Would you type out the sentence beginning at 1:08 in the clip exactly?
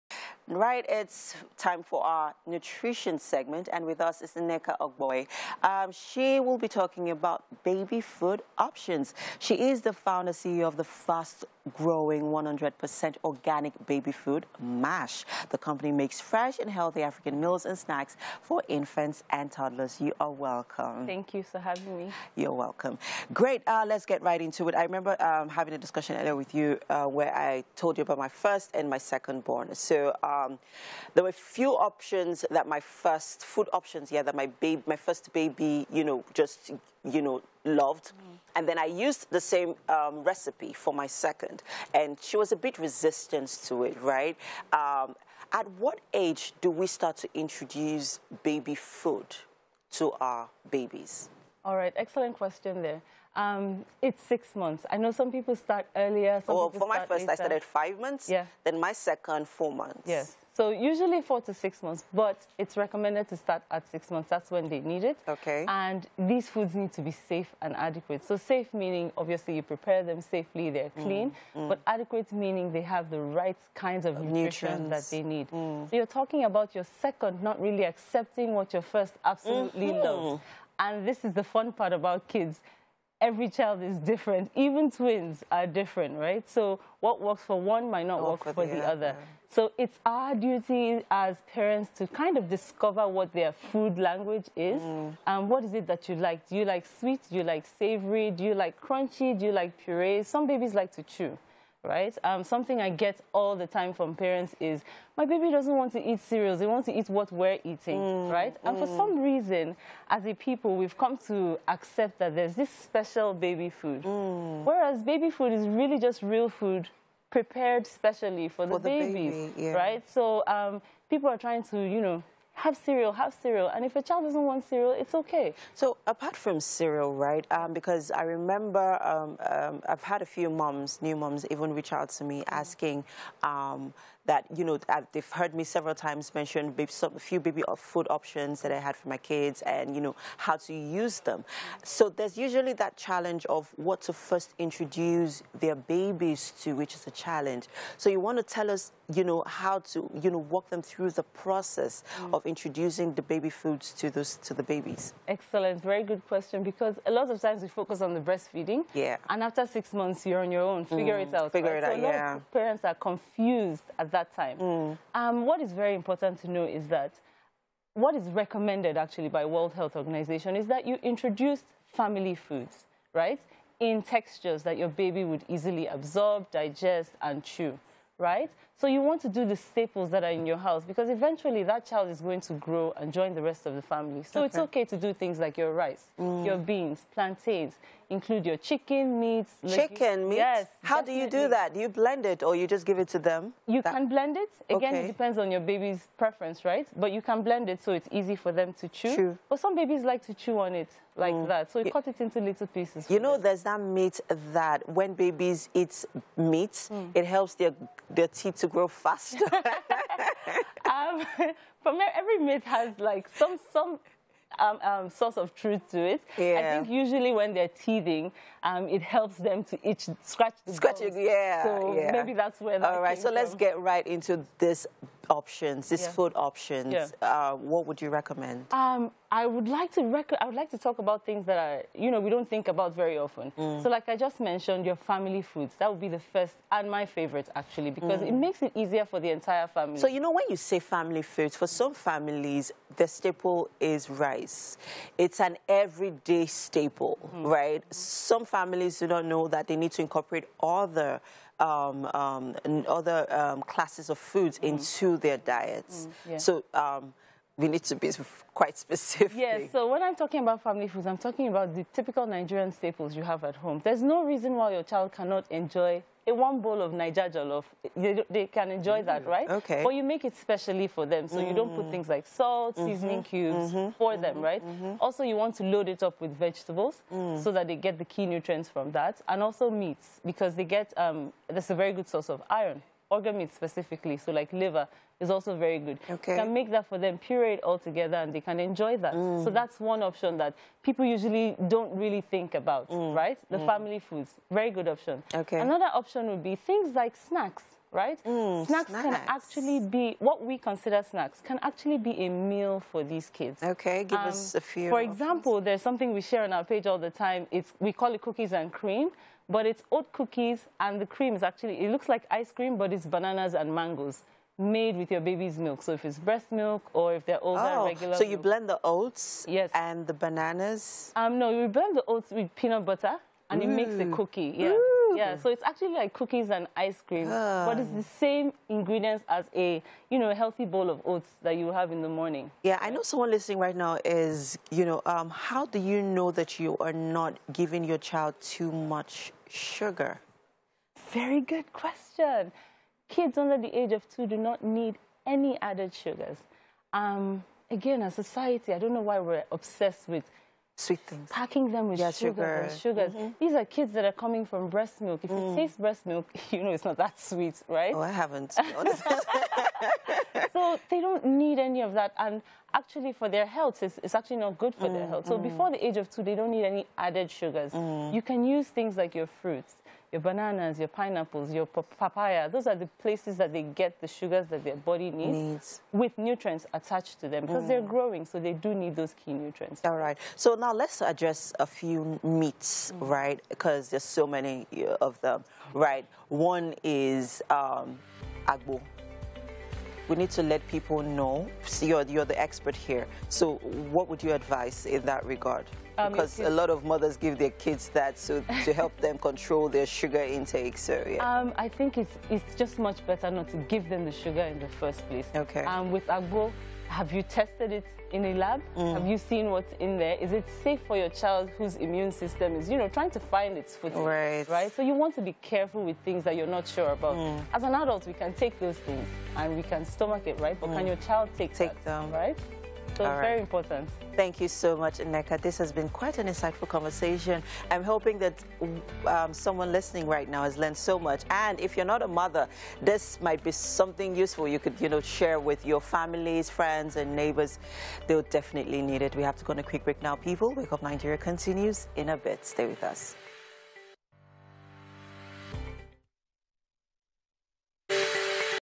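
So safe meaning, obviously, you prepare them safely, they're mm, clean, mm.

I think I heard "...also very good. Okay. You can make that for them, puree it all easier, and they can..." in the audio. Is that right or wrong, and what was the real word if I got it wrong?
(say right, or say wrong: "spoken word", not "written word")
wrong: "together", not "easier".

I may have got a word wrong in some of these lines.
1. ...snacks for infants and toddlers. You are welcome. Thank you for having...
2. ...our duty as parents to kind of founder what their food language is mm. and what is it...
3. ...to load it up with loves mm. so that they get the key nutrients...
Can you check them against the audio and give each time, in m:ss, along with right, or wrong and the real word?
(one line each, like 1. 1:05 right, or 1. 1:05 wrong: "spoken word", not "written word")
1. 0:17 right
2. 1:30 wrong: "discover", not "founder"
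3. 4:35 wrong: "vegetables", not "loves".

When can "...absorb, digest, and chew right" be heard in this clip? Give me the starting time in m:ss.
2:55.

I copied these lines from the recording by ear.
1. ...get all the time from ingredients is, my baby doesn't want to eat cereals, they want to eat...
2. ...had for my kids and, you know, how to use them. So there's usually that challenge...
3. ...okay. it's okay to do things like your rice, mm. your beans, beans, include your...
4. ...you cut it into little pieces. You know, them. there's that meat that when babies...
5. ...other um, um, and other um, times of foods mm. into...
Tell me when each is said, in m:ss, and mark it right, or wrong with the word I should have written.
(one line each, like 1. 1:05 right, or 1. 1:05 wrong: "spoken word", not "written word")
1. 1:42 wrong: "parents", not "ingredients"
2. 2:18 right
3. 3:04 wrong: "plantains", not "beans"
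4. 3:21 right
5. 4:10 wrong: "classes", not "times".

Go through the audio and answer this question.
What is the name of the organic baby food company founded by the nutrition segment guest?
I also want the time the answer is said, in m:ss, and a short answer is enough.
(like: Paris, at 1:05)
MASH, at 0:14.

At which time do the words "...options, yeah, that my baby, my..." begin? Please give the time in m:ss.
0:33.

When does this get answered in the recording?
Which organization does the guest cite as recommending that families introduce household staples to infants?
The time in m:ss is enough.
2:49.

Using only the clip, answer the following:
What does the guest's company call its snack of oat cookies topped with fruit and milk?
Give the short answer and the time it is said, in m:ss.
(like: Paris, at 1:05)
Cookies and cream, at 5:08.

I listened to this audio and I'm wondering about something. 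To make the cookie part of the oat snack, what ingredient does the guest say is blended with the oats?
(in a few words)
Peanut butter.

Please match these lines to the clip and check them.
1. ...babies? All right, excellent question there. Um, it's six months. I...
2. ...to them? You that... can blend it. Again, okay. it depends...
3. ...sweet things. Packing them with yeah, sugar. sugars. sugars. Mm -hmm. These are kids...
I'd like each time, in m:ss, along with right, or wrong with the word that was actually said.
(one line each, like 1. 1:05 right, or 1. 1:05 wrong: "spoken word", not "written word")
1. 0:50 right
2. 3:13 right
3. 5:50 right.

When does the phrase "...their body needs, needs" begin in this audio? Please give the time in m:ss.
6:14.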